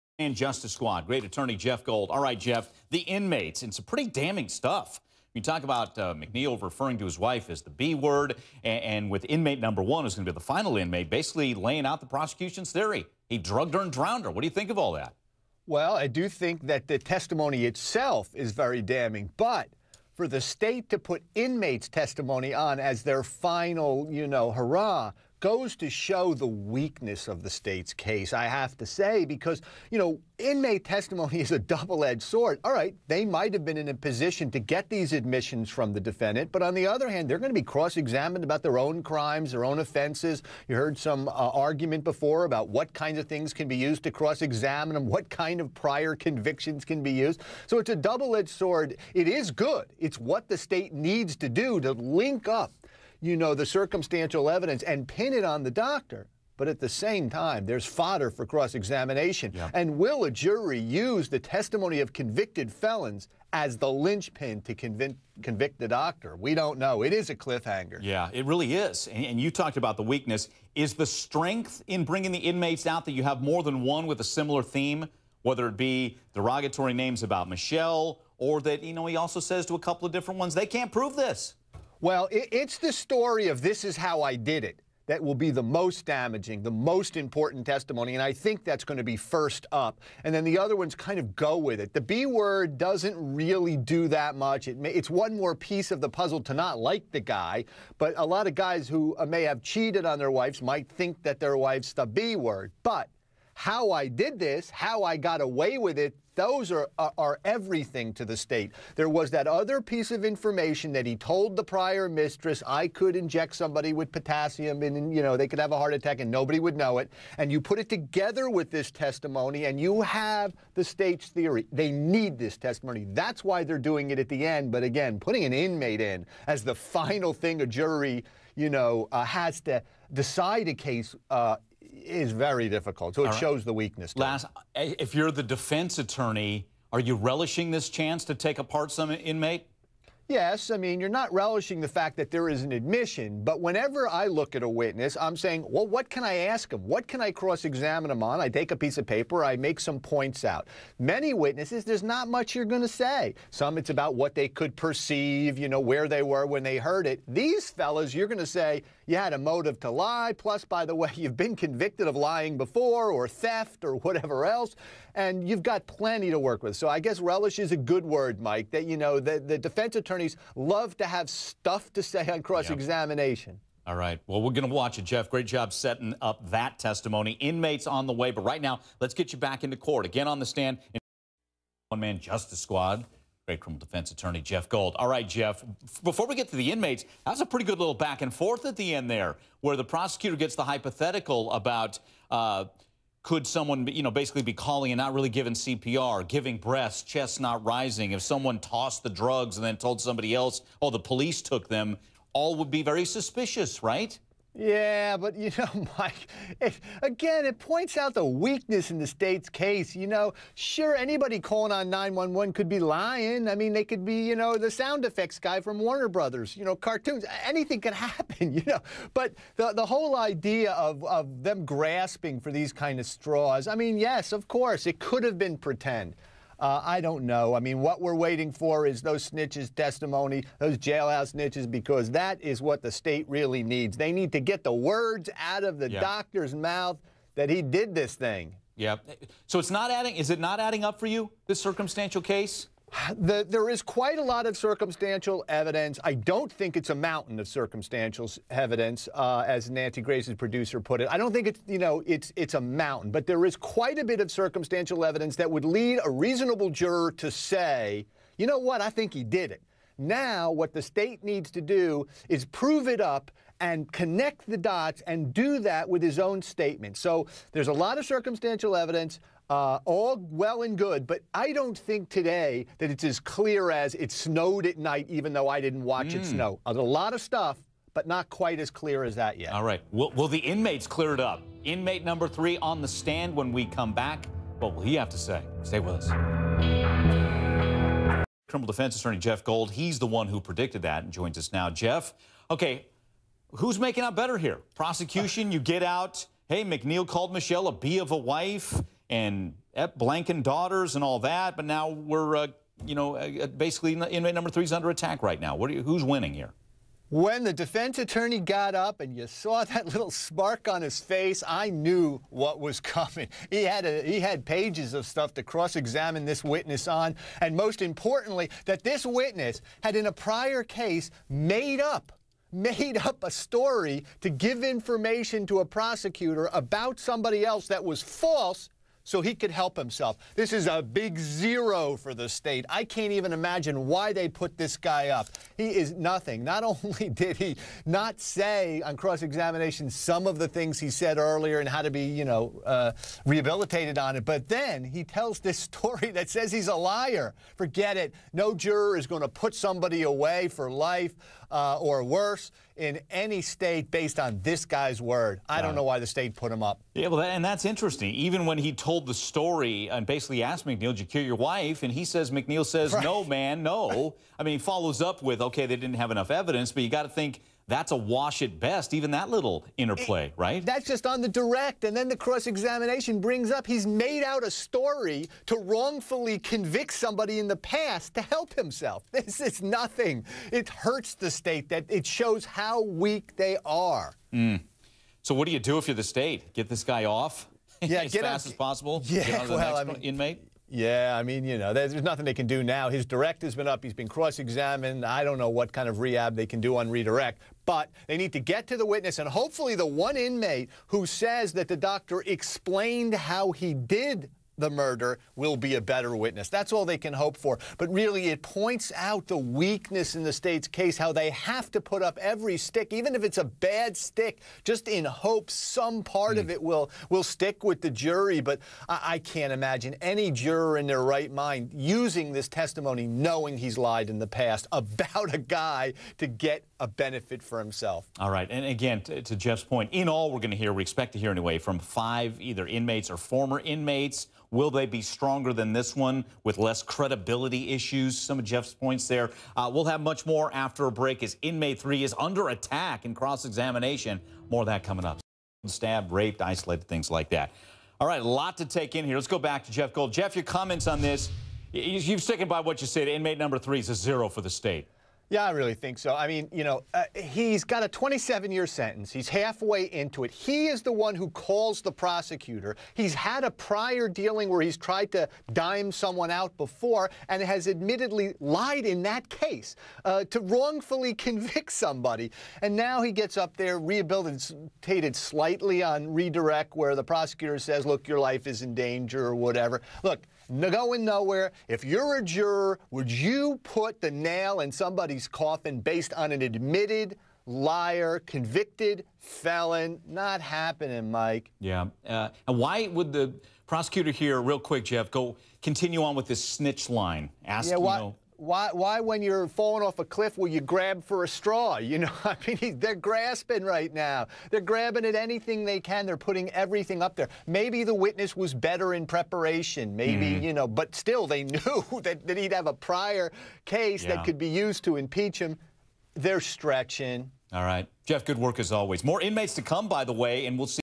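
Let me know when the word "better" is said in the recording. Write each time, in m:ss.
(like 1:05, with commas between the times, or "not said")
4:54, 6:45, 8:28.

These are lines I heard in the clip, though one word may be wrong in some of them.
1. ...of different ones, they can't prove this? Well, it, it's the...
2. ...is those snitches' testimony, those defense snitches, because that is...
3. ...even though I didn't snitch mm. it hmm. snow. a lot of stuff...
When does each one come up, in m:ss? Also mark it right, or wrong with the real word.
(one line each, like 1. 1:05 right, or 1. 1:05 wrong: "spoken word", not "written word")
1. 1:20 right
2. 3:48 wrong: "jailhouse", not "defense"
3. 4:35 wrong: "watch", not "snitch".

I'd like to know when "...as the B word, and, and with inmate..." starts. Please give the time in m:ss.
0:07.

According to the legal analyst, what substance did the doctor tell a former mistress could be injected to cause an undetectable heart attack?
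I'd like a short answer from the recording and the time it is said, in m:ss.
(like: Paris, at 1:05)
Potassium, at 1:54.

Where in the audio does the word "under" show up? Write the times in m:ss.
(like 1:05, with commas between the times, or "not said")
5:04, 7:22.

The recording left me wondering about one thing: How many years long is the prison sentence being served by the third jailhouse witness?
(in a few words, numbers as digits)
27.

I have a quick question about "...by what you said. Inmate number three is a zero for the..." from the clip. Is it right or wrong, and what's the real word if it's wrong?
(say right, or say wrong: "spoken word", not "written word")
right.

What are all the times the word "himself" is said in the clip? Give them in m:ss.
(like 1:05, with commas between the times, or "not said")
5:29, 6:18, 7:07.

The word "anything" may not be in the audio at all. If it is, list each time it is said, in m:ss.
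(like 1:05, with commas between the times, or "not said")
3:37, 8:25.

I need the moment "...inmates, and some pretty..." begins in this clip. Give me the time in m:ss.
0:02.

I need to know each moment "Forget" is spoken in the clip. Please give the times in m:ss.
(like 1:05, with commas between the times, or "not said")
5:47.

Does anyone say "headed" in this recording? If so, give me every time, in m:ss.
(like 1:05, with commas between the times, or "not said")
not said.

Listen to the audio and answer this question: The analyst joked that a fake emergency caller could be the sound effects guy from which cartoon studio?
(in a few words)
Warner Brothers.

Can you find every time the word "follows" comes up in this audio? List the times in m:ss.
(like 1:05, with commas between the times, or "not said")
6:04.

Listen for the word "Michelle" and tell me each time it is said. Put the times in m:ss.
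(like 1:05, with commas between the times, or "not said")
1:17, 4:57.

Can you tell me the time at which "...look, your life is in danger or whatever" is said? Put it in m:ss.
7:57.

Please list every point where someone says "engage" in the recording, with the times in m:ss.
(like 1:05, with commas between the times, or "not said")
not said.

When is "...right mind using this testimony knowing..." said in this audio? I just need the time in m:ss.
7:01.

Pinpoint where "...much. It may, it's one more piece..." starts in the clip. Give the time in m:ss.
1:34.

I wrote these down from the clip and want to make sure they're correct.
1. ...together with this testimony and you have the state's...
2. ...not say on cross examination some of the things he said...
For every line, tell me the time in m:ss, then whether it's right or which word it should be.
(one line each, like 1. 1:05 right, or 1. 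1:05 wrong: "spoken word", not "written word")
1. 1:57 right
2. 5:37 right.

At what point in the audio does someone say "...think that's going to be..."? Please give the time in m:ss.
1:28.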